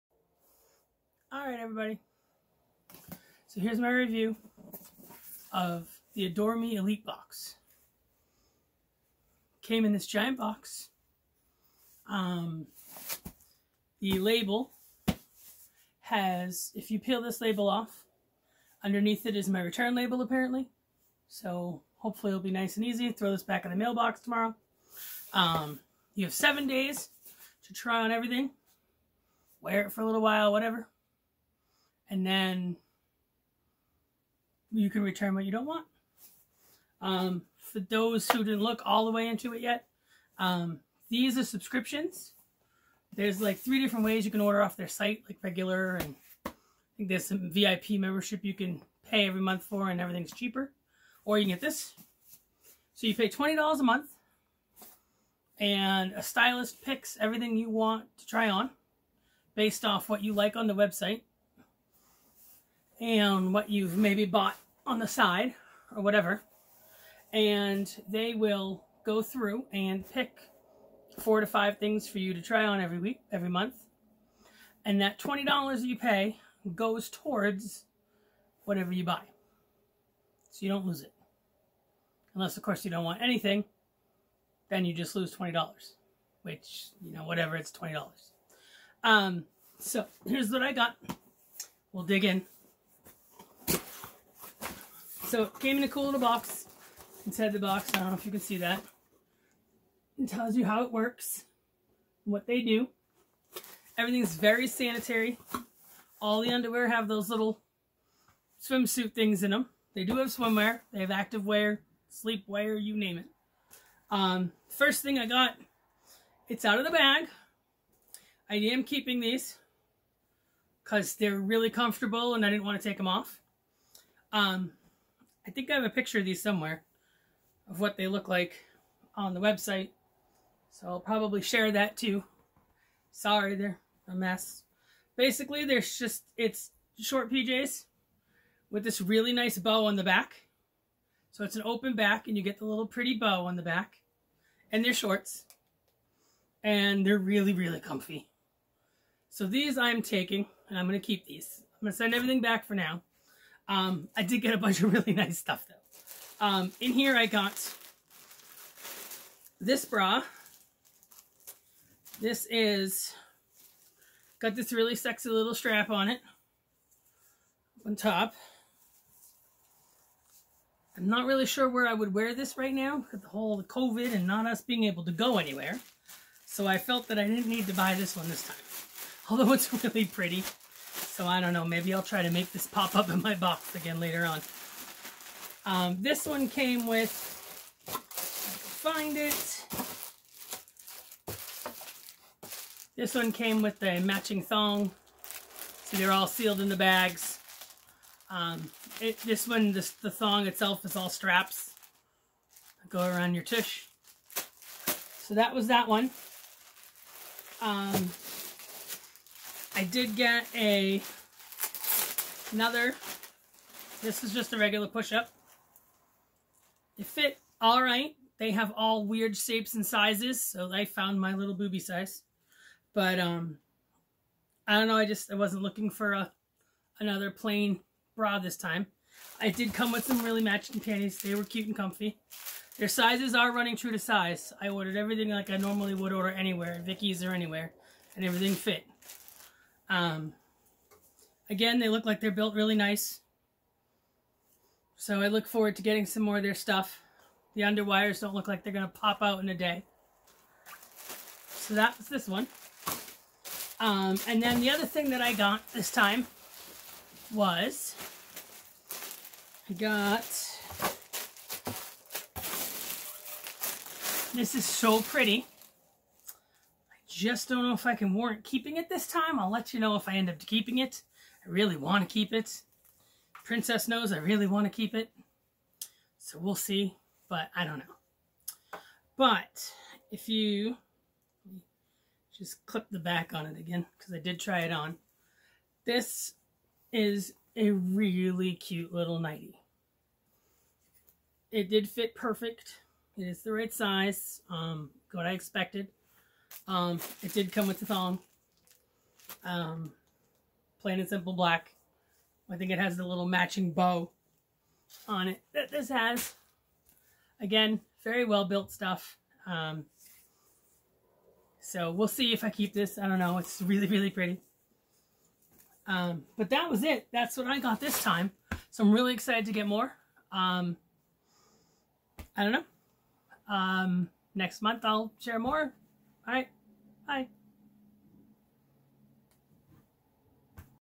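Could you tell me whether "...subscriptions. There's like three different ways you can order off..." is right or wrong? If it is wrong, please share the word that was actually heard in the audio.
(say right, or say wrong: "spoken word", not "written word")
right.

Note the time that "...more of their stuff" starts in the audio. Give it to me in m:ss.
4:06.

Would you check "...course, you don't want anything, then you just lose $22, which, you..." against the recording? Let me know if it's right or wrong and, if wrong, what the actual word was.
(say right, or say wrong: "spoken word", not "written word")
wrong: "20", not "22".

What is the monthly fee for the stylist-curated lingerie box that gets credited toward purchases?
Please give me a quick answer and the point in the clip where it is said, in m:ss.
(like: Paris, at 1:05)
$20, at 0:53.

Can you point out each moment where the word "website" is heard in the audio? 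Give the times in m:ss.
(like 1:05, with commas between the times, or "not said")
1:00, 2:09.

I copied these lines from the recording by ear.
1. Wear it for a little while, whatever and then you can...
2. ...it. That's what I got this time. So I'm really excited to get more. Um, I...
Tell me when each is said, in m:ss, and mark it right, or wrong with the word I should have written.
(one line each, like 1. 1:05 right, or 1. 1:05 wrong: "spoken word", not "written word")
1. 0:29 right
2. 5:16 right.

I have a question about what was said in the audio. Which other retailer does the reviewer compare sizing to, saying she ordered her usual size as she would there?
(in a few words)
Vicky's.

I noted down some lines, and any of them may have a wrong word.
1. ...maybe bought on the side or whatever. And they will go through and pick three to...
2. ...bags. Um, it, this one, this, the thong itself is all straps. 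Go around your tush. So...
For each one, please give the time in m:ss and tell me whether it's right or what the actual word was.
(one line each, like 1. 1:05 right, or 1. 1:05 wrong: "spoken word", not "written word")
1. 1:03 wrong: "four", not "three"
2. 3:16 right.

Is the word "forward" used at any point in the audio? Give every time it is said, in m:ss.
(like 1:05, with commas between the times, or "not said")
4:05.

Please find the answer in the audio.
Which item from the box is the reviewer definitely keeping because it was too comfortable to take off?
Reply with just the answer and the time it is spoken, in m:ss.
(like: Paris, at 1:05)
Short PJs, at 2:16.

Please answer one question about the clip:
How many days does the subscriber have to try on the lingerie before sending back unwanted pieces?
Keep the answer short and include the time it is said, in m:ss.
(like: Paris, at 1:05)
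7, at 0:26.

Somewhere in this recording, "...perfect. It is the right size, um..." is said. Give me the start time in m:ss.
4:52.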